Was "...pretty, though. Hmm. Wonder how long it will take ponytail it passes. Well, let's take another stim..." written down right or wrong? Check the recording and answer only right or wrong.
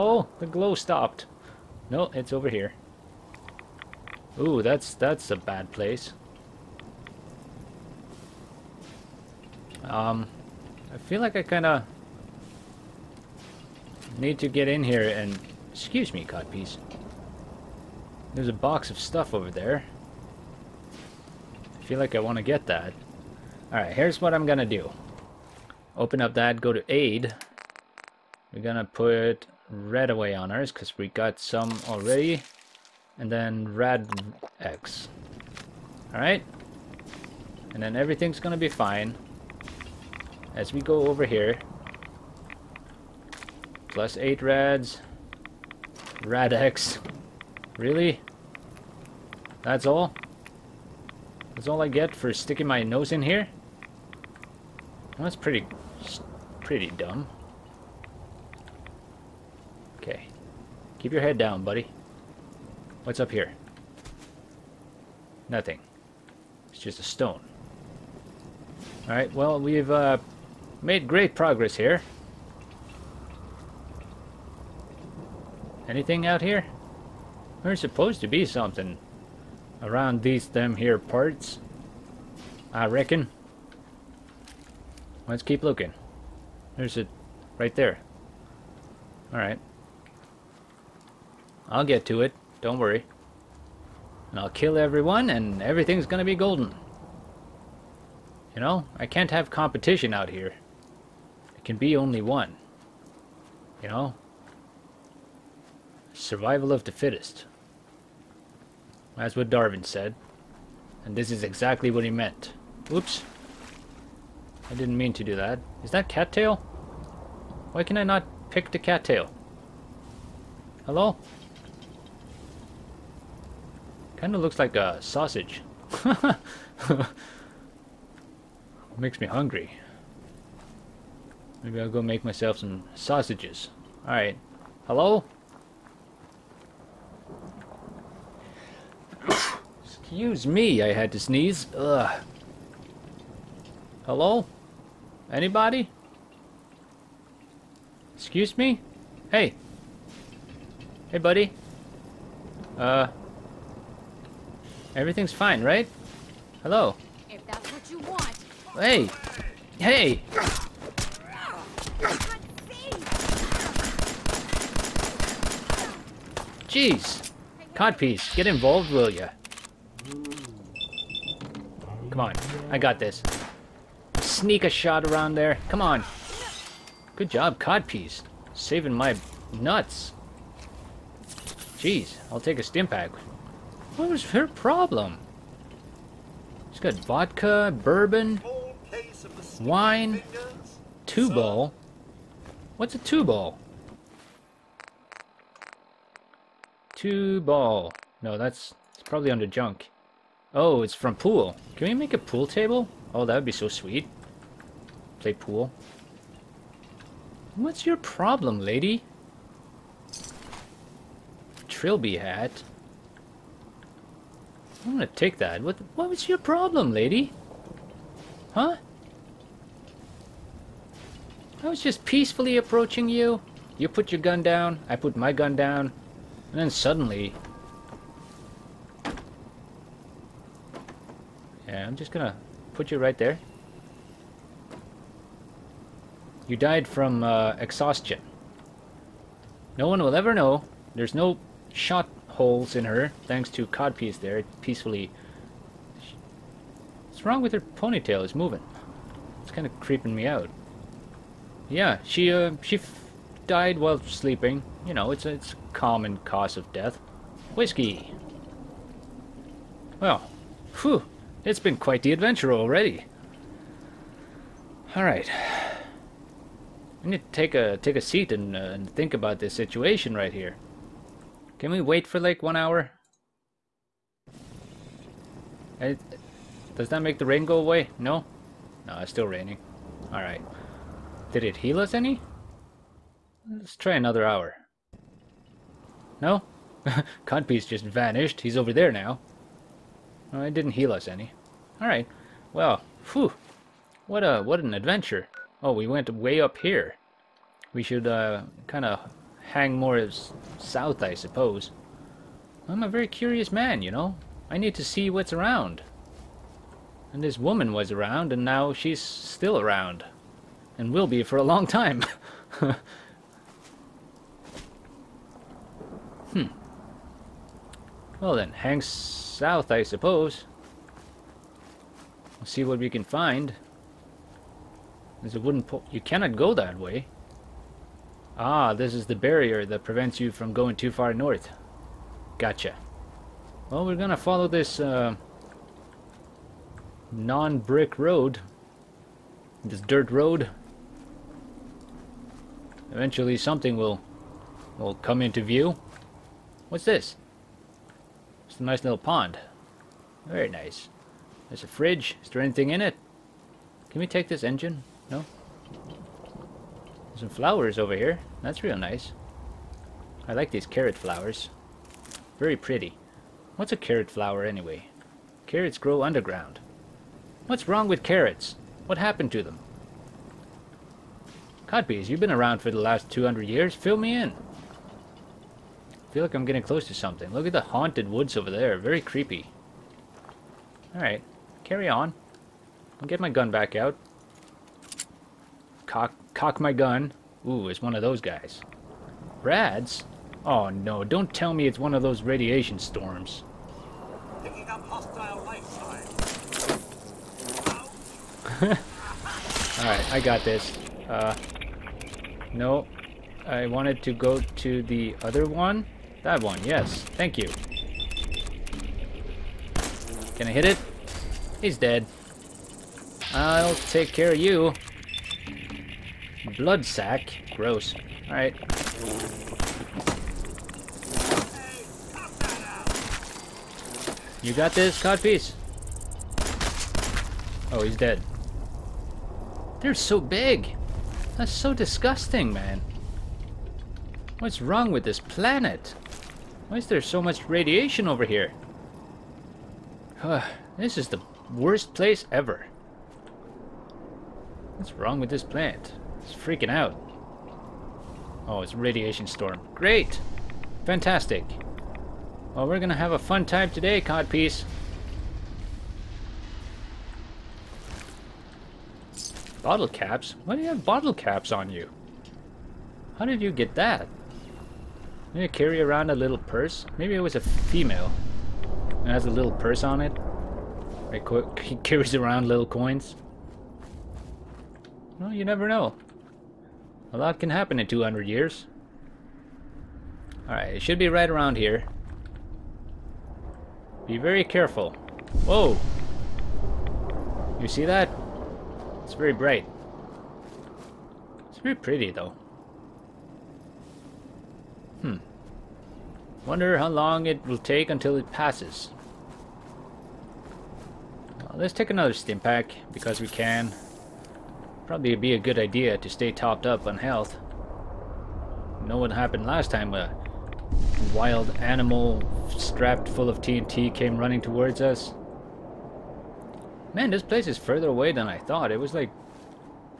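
wrong.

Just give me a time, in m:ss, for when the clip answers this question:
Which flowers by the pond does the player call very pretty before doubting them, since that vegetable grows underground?
6:00.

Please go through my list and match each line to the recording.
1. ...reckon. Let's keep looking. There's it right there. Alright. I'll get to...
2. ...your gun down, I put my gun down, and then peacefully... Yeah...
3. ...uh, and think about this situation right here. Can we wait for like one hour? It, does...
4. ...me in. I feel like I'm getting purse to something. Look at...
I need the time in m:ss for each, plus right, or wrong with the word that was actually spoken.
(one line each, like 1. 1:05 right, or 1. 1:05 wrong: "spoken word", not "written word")
1. 1:22 right
2. 3:44 wrong: "suddenly", not "peacefully"
3. 4:28 right
4. 6:13 wrong: "close", not "purse".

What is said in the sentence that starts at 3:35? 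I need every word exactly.
What, what was your problem, lady?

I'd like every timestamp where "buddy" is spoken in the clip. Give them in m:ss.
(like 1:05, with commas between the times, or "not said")
1:01, 2:31.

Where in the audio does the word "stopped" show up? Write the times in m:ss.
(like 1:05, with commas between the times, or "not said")
0:00.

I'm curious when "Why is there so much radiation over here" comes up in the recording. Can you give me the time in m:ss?
7:16.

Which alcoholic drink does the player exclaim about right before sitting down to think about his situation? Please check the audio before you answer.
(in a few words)
Whiskey.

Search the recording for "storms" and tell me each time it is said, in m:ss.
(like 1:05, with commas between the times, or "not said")
6:32, 7:29.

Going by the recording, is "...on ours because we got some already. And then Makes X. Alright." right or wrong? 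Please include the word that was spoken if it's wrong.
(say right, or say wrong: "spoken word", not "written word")
wrong: "Rad", not "Makes".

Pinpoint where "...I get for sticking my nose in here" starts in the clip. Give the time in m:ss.
0:51.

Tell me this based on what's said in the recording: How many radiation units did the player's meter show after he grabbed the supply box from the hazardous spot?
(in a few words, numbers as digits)
8.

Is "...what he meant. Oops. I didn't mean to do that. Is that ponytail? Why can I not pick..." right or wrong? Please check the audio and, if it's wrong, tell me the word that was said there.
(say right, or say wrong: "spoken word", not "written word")
wrong: "cattail", not "ponytail".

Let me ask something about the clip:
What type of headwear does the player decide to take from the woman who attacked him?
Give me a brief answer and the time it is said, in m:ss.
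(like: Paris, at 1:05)
Trilby hat, at 3:31.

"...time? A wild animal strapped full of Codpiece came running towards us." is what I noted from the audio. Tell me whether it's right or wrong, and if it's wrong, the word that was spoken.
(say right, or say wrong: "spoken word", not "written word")
wrong: "TNT", not "Codpiece".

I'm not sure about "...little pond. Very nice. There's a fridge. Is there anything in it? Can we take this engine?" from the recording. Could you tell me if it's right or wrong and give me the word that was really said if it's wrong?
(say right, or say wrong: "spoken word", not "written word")
right.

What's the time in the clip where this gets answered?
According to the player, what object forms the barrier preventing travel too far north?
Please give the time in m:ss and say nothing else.
5:25.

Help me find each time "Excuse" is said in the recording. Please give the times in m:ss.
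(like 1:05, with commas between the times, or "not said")
0:15, 2:19, 2:28.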